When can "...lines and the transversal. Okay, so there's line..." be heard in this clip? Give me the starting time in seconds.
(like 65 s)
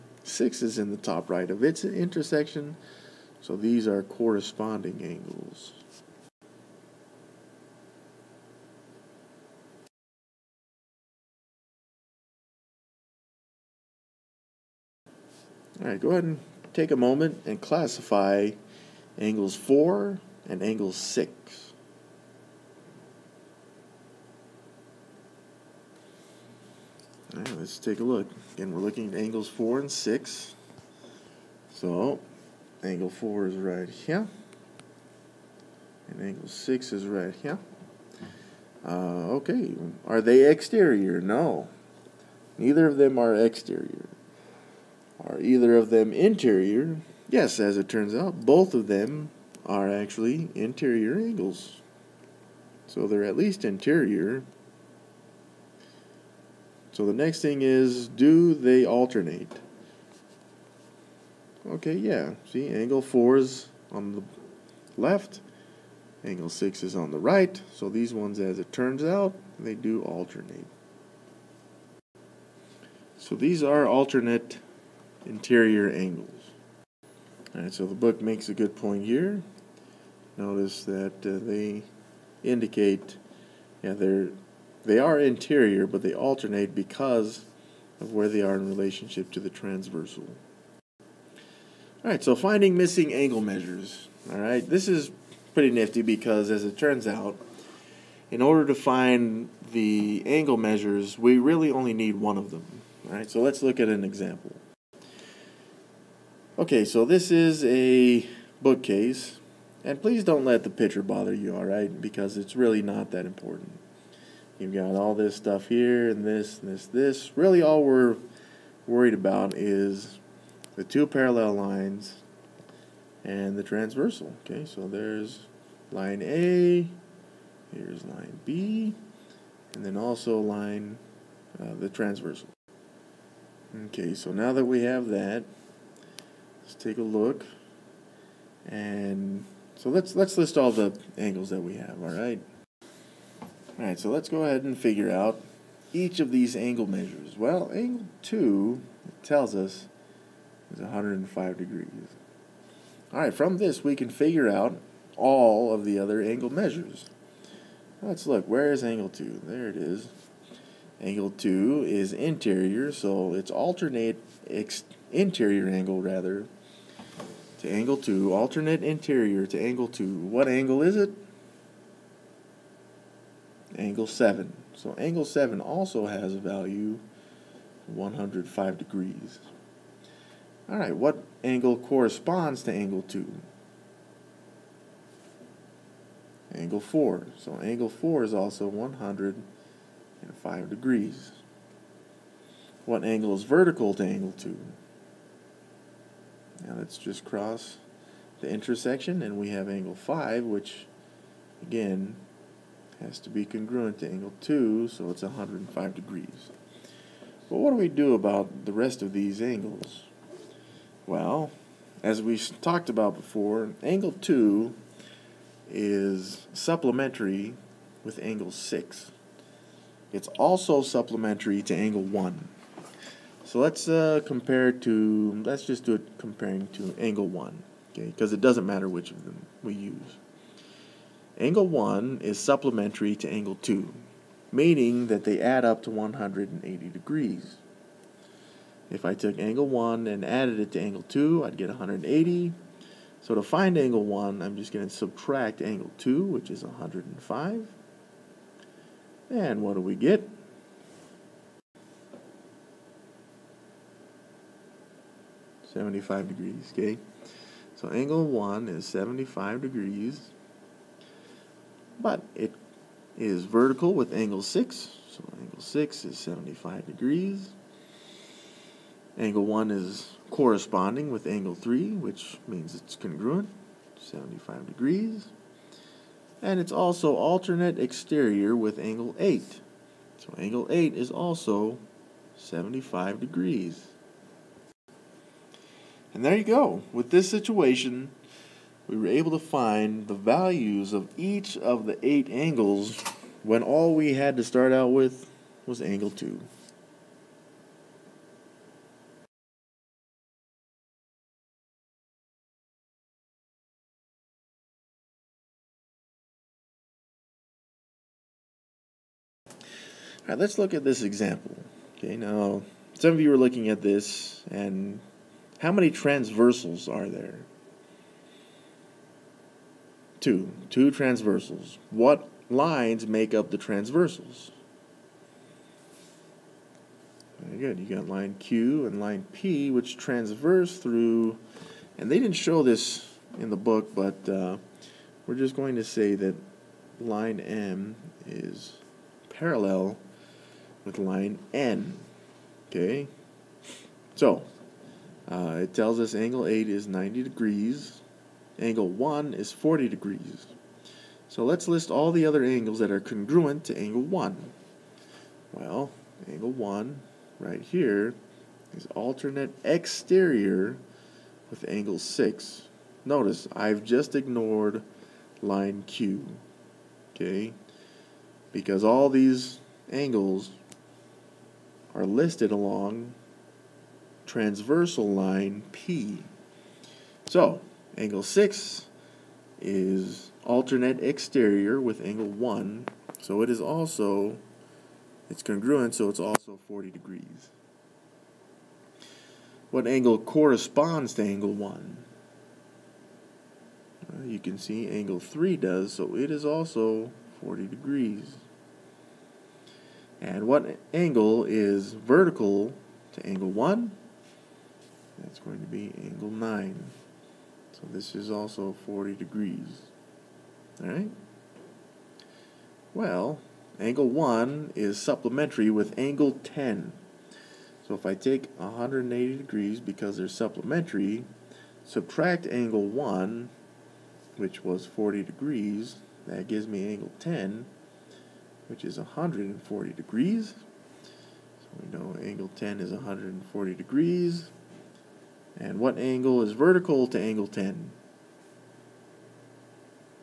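121 s.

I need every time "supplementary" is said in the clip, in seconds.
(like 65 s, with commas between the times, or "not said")
216 s, 220 s, 232 s, 414 s, 420 s.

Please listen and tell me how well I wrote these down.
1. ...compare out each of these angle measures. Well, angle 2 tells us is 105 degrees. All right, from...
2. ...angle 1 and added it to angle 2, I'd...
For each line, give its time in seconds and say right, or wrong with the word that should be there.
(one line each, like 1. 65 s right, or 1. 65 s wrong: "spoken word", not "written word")
1. 144 s wrong: "figure", not "compare"
2. 239 s right.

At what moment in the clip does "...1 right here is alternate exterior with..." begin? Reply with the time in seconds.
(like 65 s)
356 s.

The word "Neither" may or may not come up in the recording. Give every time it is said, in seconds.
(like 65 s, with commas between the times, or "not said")
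42 s.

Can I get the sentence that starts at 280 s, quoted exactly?
So angle 8 is also 75 degrees.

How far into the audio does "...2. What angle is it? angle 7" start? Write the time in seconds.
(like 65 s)
169 s.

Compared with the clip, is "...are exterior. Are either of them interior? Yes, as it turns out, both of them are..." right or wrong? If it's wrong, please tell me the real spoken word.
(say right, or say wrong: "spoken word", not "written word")
right.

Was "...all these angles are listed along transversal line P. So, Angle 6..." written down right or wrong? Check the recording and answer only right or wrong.
right.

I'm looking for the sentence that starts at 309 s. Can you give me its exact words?
All right, let's look at this example.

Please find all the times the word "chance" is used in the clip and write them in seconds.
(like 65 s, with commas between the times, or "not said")
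not said.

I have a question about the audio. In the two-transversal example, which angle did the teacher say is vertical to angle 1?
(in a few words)
Angle 9.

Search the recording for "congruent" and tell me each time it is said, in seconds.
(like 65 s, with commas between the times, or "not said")
203 s, 272 s, 352 s, 385 s.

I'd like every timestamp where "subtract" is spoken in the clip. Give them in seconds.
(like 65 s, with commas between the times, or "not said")
244 s, 421 s.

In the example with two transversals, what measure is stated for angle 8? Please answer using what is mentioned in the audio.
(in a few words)
90 degrees.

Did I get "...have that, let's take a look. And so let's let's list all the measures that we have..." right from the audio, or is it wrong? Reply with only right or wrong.
wrong.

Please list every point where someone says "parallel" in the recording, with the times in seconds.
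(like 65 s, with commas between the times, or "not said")
121 s, 339 s.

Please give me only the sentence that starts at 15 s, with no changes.
All right, go ahead and take a moment and classify angles 4 and angles 6.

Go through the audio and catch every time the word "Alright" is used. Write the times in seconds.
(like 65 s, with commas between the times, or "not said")
77 s, 410 s.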